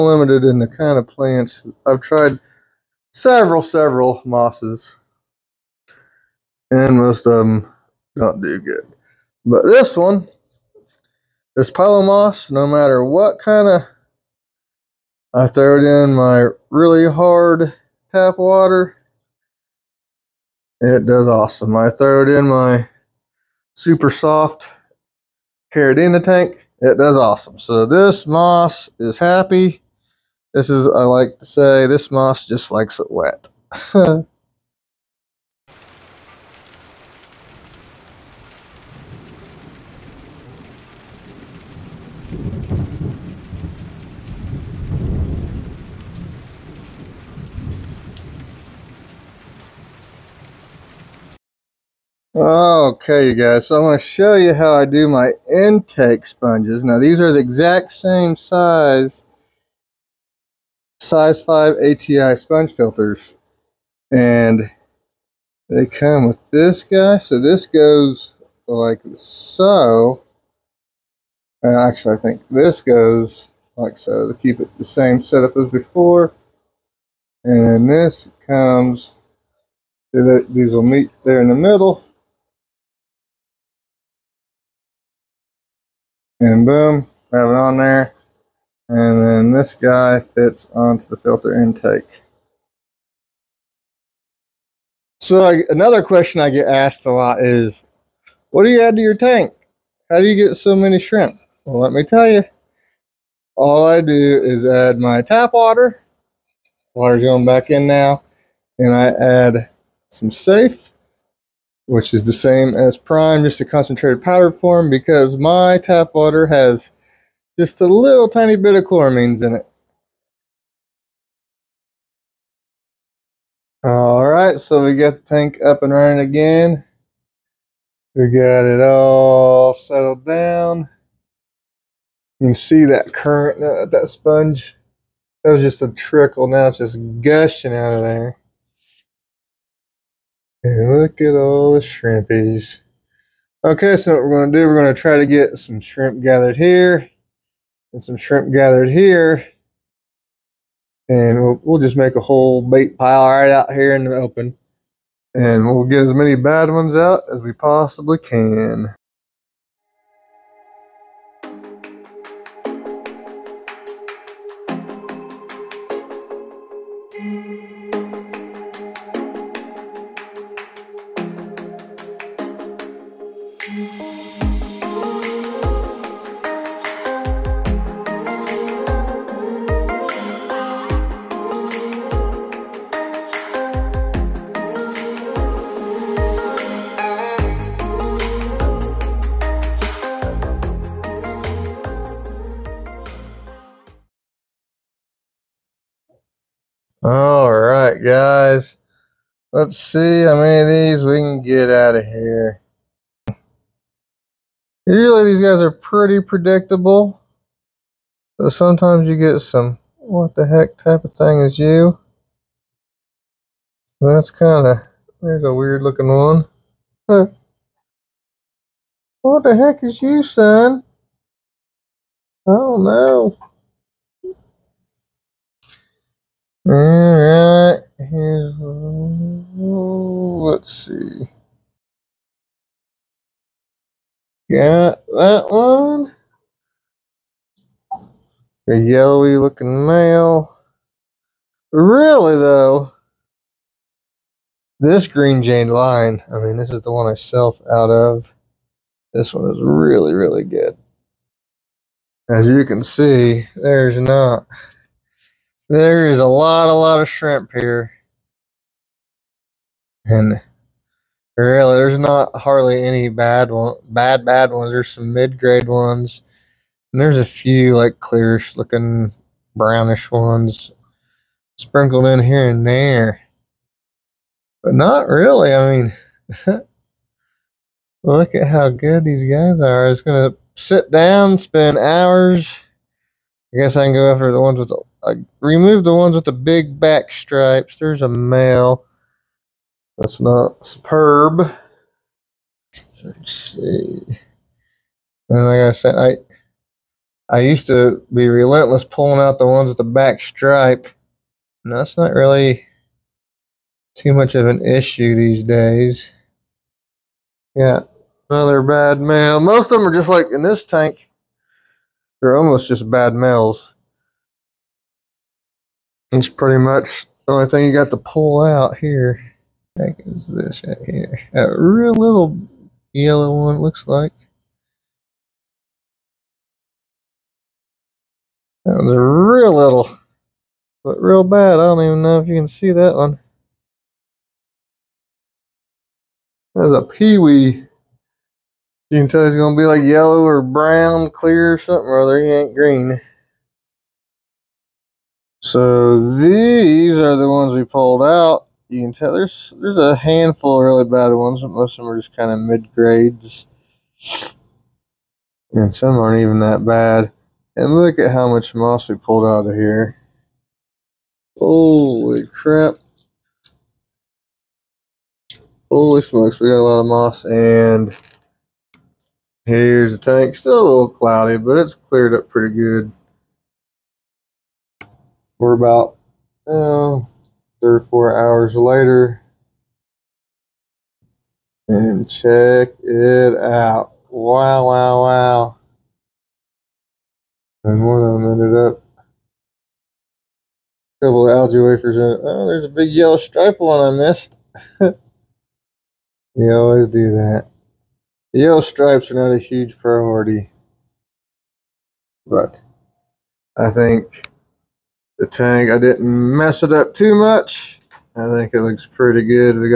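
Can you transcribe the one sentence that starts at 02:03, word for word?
All right, so we got the tank up and running again.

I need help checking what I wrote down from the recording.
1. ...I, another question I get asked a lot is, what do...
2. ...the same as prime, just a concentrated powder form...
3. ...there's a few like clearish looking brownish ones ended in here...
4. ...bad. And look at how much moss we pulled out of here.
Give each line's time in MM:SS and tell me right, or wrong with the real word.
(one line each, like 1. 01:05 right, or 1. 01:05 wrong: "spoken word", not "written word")
1. 01:35 right
2. 01:52 right
3. 04:27 wrong: "sprinkled", not "ended"
4. 05:56 right.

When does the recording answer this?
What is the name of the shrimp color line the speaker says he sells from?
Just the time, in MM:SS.
04:05.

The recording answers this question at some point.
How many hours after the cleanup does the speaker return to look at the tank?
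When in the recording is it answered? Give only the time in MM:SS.
06:17.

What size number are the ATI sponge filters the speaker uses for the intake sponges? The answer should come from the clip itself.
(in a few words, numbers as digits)
5.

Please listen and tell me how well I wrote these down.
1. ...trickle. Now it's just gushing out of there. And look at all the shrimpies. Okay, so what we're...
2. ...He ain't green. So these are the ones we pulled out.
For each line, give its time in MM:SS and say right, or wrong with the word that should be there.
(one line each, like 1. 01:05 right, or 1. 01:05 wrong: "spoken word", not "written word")
1. 02:15 right
2. 05:42 right.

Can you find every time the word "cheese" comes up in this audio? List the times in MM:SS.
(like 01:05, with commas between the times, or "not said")
not said.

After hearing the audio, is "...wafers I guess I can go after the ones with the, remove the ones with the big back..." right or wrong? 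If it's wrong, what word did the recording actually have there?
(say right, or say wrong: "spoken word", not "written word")
wrong: "hours", not "wafers".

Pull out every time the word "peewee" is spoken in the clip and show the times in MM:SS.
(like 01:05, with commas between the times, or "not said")
05:36.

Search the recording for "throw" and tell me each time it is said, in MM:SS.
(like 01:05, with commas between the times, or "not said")
00:15, 00:21.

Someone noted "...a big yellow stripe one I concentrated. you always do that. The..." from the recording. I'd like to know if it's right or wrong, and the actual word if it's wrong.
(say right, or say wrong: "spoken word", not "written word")
wrong: "missed", not "concentrated".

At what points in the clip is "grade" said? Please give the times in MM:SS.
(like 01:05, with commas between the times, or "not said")
04:25, 05:52.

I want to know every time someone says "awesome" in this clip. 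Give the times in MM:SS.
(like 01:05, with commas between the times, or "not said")
00:21, 00:27.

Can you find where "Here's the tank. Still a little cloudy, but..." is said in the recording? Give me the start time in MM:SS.
06:09.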